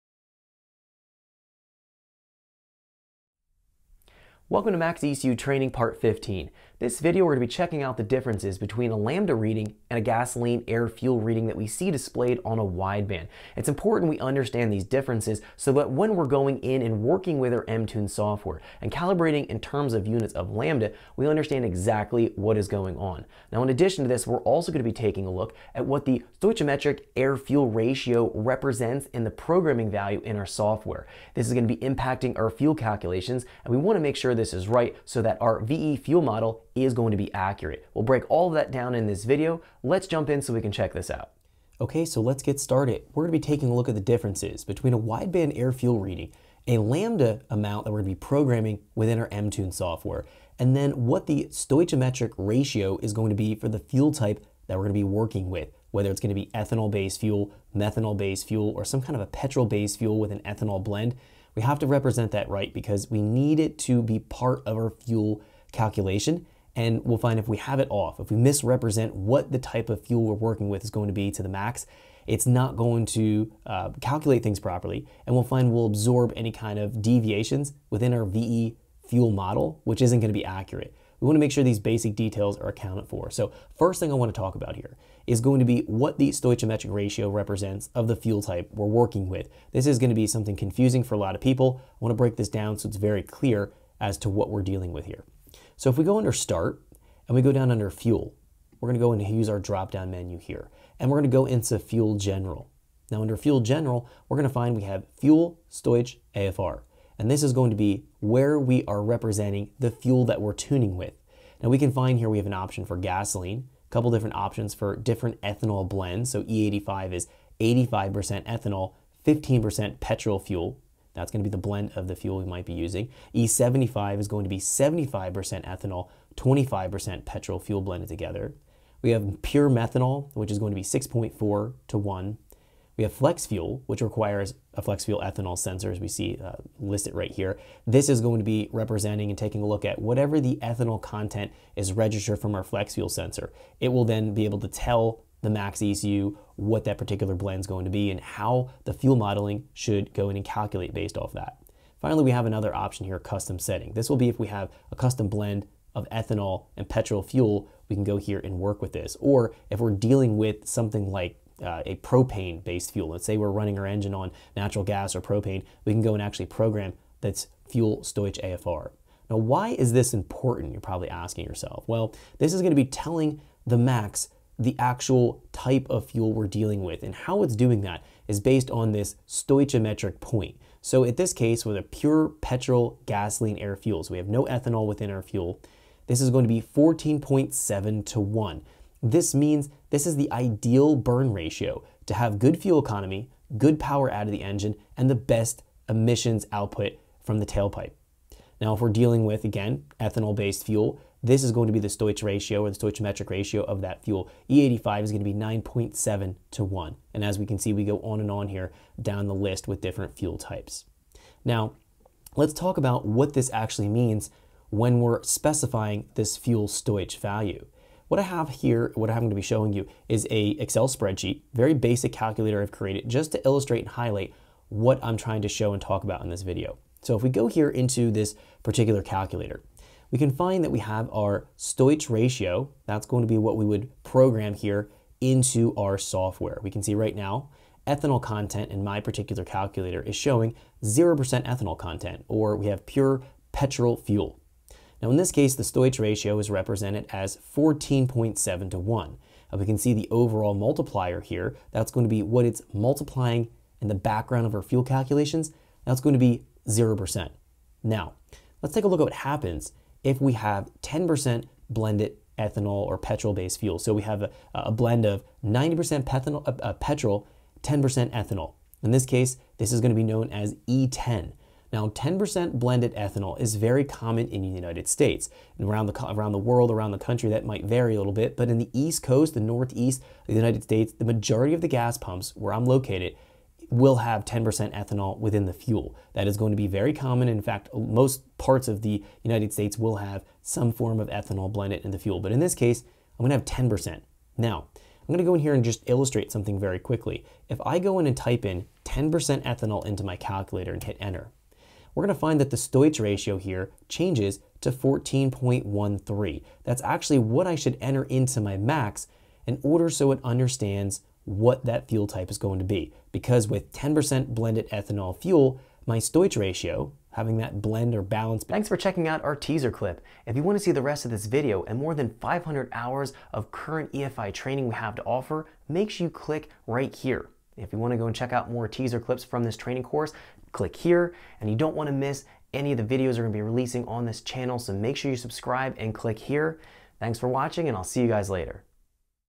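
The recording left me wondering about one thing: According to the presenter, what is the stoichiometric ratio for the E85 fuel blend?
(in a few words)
9.7 to 1.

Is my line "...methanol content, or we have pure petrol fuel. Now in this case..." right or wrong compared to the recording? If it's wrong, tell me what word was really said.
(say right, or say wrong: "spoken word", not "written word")
wrong: "ethanol", not "methanol".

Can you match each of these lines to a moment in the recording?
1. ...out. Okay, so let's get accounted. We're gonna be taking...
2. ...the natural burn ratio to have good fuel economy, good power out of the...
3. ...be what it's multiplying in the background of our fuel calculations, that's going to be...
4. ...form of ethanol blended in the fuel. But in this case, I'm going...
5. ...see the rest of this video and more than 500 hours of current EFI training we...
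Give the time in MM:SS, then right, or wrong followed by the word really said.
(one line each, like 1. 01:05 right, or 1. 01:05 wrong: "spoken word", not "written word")
1. 00:41 wrong: "started", not "accounted"
2. 03:10 wrong: "ideal", not "natural"
3. 04:12 right
4. 04:50 right
5. 05:20 right.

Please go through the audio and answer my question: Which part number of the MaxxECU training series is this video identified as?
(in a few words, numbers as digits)
Part 15.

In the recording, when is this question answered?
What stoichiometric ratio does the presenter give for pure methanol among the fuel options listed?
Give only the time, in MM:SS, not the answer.
02:10.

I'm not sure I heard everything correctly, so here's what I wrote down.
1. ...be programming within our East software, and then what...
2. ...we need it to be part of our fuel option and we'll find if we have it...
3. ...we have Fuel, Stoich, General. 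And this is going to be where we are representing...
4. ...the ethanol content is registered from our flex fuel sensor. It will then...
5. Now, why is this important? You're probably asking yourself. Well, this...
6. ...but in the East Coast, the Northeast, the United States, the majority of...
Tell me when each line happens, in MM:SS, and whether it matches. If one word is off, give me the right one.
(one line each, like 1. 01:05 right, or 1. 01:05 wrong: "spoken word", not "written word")
1. 00:48 wrong: "MTune", not "East"
2. 01:03 wrong: "calculation", not "option"
3. 01:44 wrong: "AFR", not "General"
4. 02:20 right
5. 02:49 right
6. 04:38 right.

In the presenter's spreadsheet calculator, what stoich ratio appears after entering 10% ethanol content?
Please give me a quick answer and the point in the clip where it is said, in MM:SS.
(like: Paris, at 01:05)
14.13, at 05:04.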